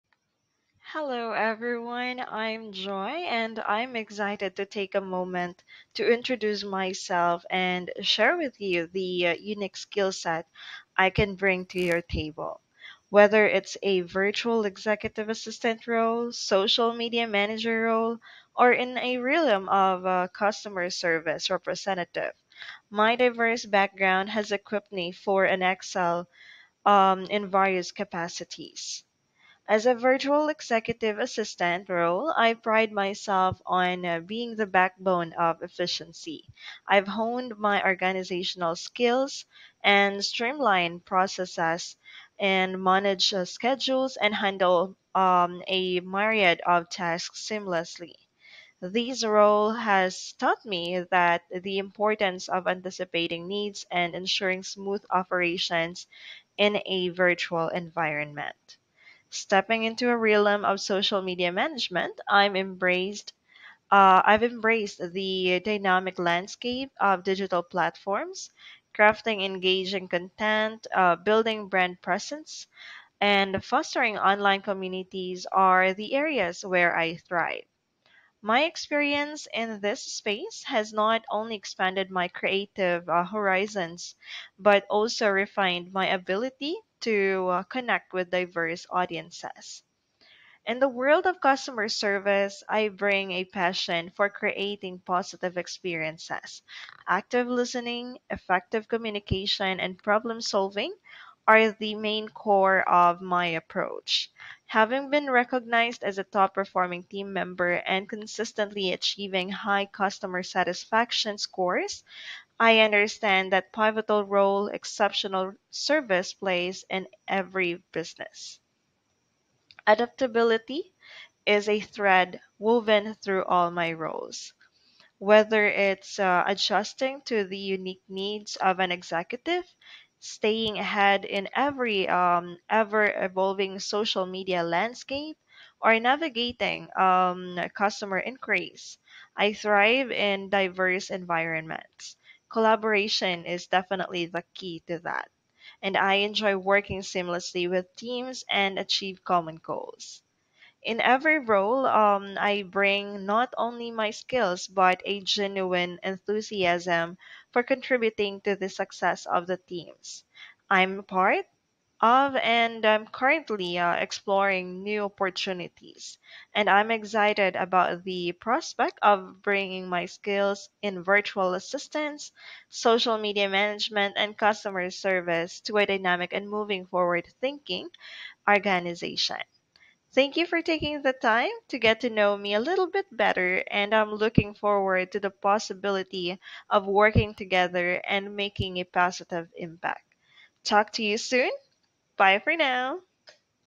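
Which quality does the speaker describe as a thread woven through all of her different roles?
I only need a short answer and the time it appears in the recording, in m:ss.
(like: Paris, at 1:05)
Adaptability, at 1:59.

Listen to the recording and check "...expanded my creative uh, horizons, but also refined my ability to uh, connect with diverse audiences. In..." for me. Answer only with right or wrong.
right.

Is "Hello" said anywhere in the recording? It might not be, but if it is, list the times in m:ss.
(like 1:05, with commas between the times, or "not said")
0:00.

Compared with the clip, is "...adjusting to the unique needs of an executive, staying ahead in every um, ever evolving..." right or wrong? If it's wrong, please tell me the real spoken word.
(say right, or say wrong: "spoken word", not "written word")
right.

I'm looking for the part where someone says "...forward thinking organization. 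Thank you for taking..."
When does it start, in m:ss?
2:56.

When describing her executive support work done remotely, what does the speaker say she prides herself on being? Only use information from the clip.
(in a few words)
the backbone of efficiency.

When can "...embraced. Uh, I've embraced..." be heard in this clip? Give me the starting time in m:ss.
1:02.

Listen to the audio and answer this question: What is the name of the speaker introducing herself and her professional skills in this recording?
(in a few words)
Joy.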